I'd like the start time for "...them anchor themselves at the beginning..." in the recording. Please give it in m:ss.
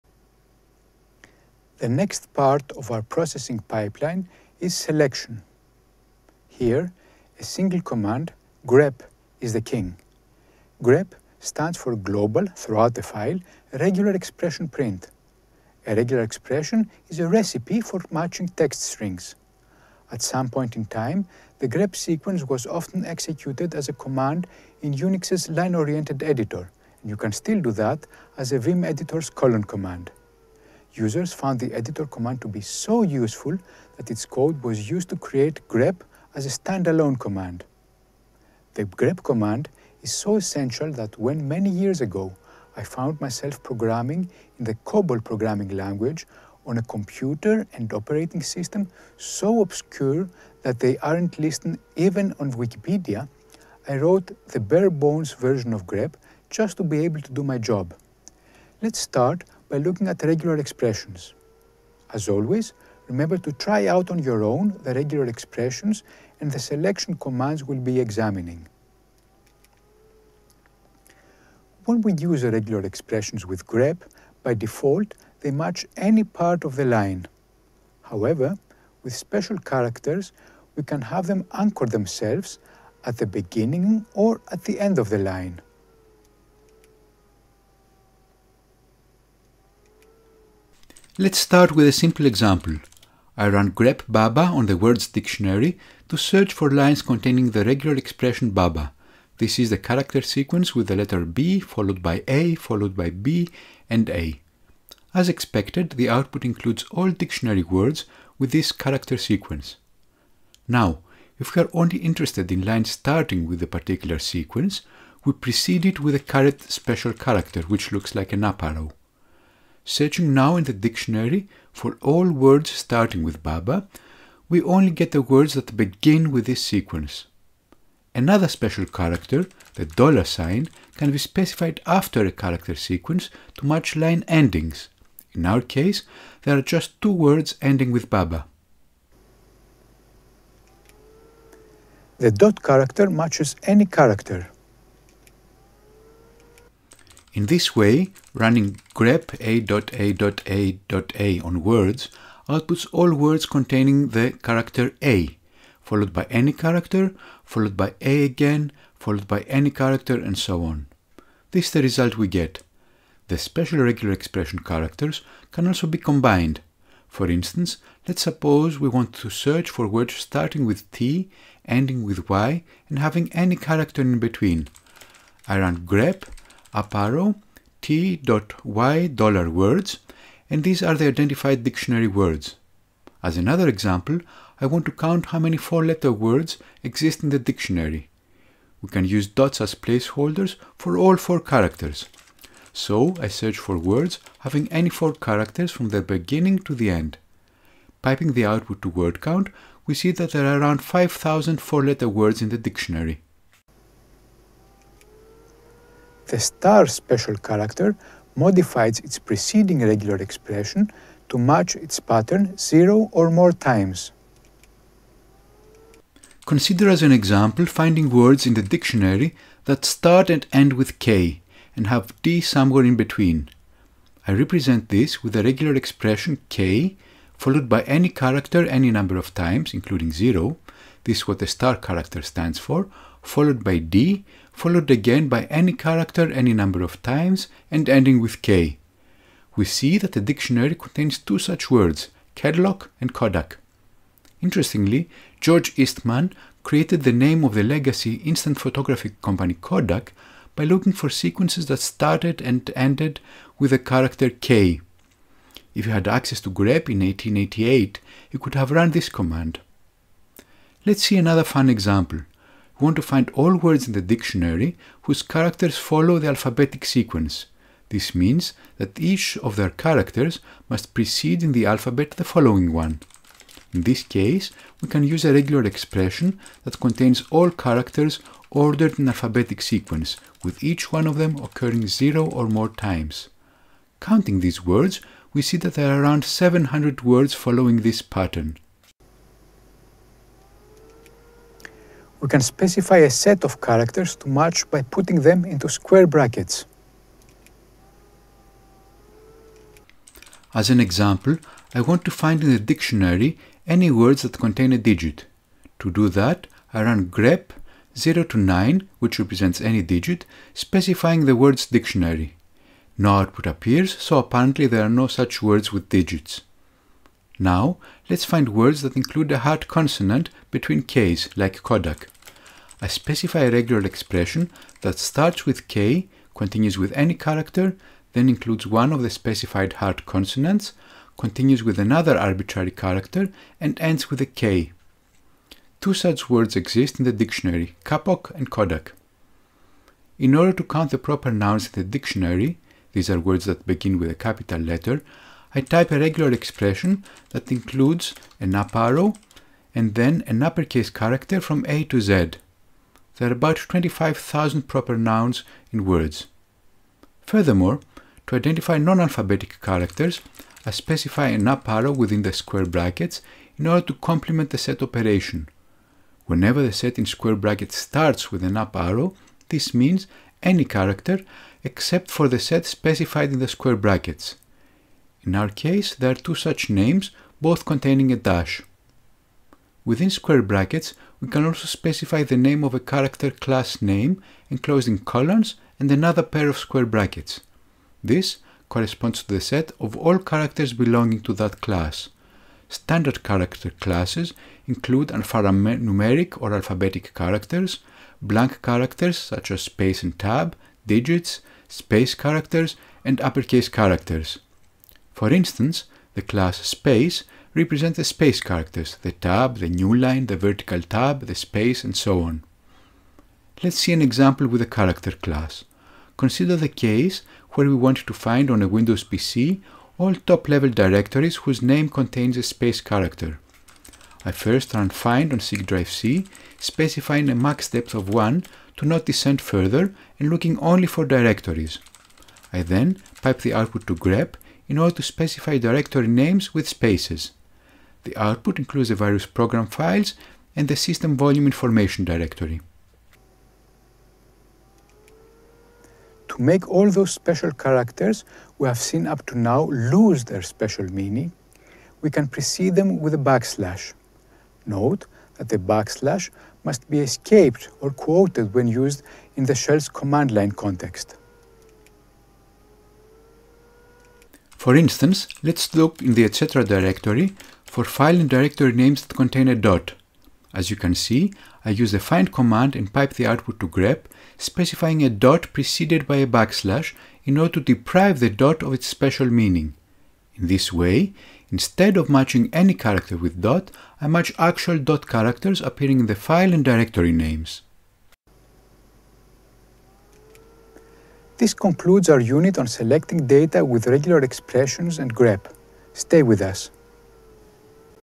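1:21.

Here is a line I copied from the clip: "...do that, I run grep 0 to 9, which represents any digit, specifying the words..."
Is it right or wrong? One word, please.
right.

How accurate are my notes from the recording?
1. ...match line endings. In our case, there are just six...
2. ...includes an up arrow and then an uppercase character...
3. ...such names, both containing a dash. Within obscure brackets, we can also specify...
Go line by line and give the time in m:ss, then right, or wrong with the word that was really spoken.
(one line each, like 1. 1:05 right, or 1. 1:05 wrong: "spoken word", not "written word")
1. 2:13 wrong: "two", not "six"
2. 5:47 right
3. 6:16 wrong: "square", not "obscure".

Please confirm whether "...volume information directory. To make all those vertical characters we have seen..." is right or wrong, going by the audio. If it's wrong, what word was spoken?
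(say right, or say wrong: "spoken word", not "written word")
wrong: "special", not "vertical".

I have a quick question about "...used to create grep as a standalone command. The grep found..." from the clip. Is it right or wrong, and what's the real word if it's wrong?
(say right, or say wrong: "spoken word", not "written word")
wrong: "command", not "found".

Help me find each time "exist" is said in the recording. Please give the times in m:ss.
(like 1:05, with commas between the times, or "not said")
3:06, 5:36.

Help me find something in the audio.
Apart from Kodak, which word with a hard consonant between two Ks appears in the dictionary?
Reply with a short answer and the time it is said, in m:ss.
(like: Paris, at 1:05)
kapok, at 5:37.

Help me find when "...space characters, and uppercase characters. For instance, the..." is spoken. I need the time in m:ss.
6:41.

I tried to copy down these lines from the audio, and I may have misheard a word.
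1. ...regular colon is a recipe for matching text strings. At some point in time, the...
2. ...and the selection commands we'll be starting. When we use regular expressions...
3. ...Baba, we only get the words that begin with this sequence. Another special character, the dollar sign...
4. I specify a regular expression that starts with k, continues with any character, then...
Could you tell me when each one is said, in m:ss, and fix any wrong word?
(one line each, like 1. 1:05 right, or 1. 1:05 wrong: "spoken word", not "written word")
1. 0:15 wrong: "expression", not "colon"
2. 1:06 wrong: "examining", not "starting"
3. 2:03 right
4. 5:22 right.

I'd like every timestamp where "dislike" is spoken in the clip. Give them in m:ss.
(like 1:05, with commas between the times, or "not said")
not said.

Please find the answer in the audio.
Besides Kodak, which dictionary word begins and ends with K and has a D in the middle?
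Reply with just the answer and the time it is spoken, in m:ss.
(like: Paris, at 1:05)
Kedlock, at 4:02.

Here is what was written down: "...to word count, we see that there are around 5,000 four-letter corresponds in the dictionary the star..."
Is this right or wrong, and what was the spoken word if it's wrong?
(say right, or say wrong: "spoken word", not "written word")
wrong: "words", not "corresponds".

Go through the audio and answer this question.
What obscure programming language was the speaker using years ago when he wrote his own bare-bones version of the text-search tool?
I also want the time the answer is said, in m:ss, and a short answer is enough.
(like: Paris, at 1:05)
COBOL, at 0:44.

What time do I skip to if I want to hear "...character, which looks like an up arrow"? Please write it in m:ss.
1:57.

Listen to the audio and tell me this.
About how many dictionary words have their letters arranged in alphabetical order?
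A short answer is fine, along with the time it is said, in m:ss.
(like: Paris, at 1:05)
700, at 4:46.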